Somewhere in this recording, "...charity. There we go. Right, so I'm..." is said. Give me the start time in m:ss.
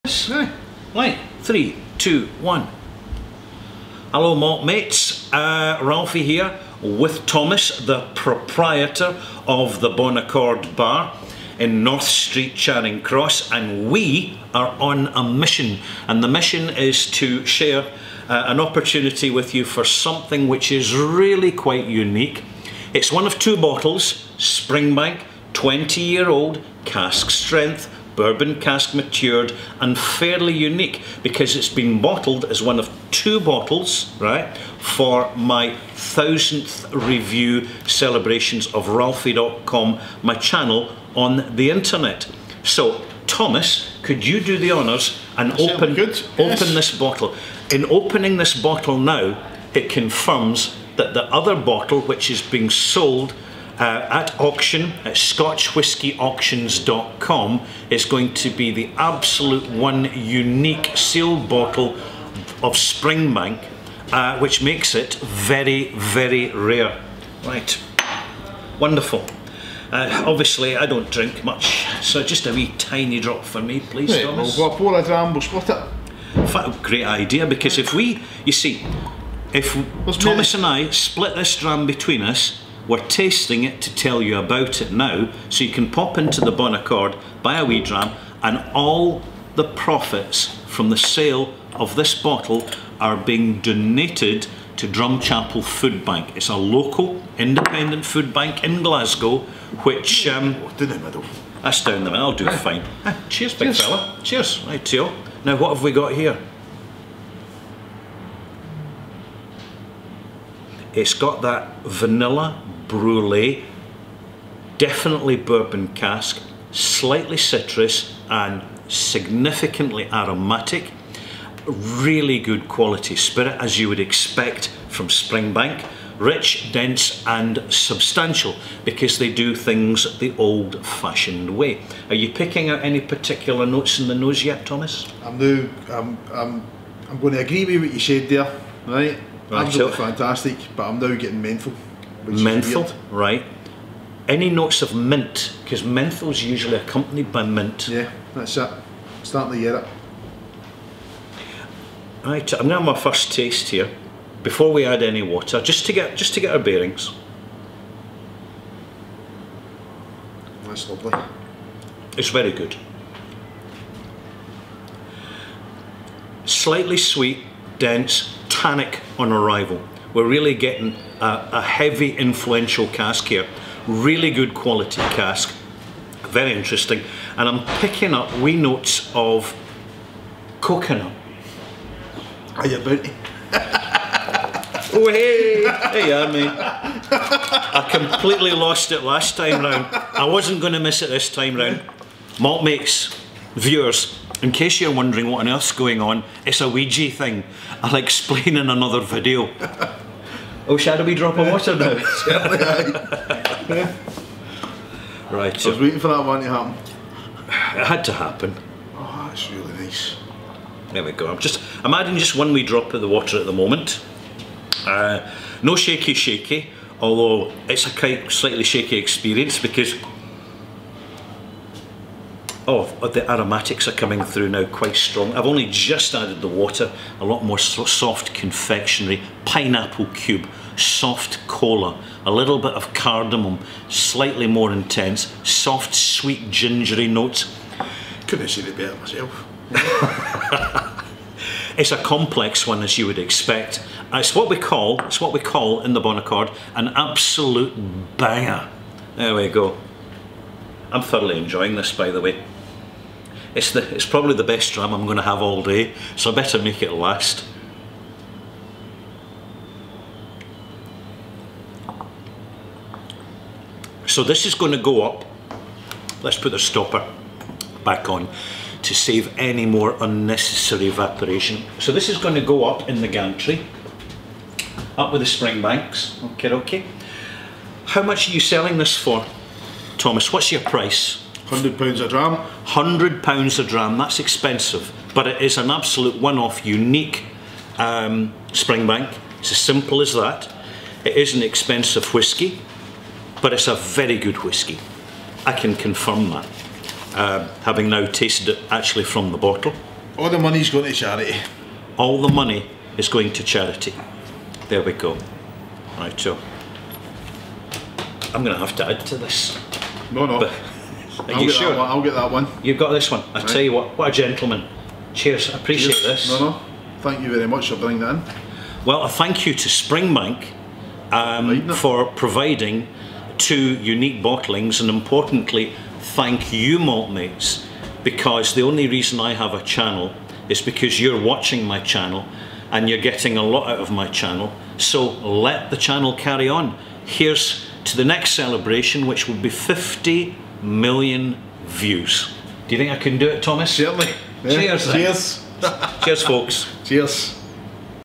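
5:03.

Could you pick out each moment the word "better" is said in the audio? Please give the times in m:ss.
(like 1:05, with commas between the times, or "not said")
3:58, 4:16.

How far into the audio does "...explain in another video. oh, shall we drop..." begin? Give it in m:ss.
3:17.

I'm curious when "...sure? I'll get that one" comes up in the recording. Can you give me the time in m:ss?
5:11.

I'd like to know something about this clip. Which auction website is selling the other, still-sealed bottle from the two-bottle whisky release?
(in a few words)
scotchwhiskyauctions.com.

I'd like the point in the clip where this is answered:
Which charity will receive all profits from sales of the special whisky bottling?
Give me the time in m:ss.
1:34.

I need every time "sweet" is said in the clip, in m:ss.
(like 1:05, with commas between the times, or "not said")
2:46, 3:55.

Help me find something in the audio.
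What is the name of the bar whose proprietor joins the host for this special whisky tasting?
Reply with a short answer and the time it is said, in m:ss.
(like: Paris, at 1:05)
Bon Accord Bar, at 0:09.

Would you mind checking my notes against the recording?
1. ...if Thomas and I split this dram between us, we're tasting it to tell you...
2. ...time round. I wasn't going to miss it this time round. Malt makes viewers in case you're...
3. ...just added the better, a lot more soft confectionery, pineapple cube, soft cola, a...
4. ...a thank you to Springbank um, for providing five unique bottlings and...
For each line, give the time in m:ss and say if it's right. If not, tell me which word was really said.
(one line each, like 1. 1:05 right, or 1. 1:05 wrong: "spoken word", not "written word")
1. 1:19 right
2. 3:09 right
3. 3:45 wrong: "water", not "better"
4. 5:19 wrong: "two", not "five".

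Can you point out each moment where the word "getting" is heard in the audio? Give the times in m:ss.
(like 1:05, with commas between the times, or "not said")
2:21, 2:50, 5:33.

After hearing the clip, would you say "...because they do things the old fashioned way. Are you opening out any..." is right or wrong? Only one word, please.
wrong.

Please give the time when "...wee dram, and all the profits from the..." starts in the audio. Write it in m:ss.
1:27.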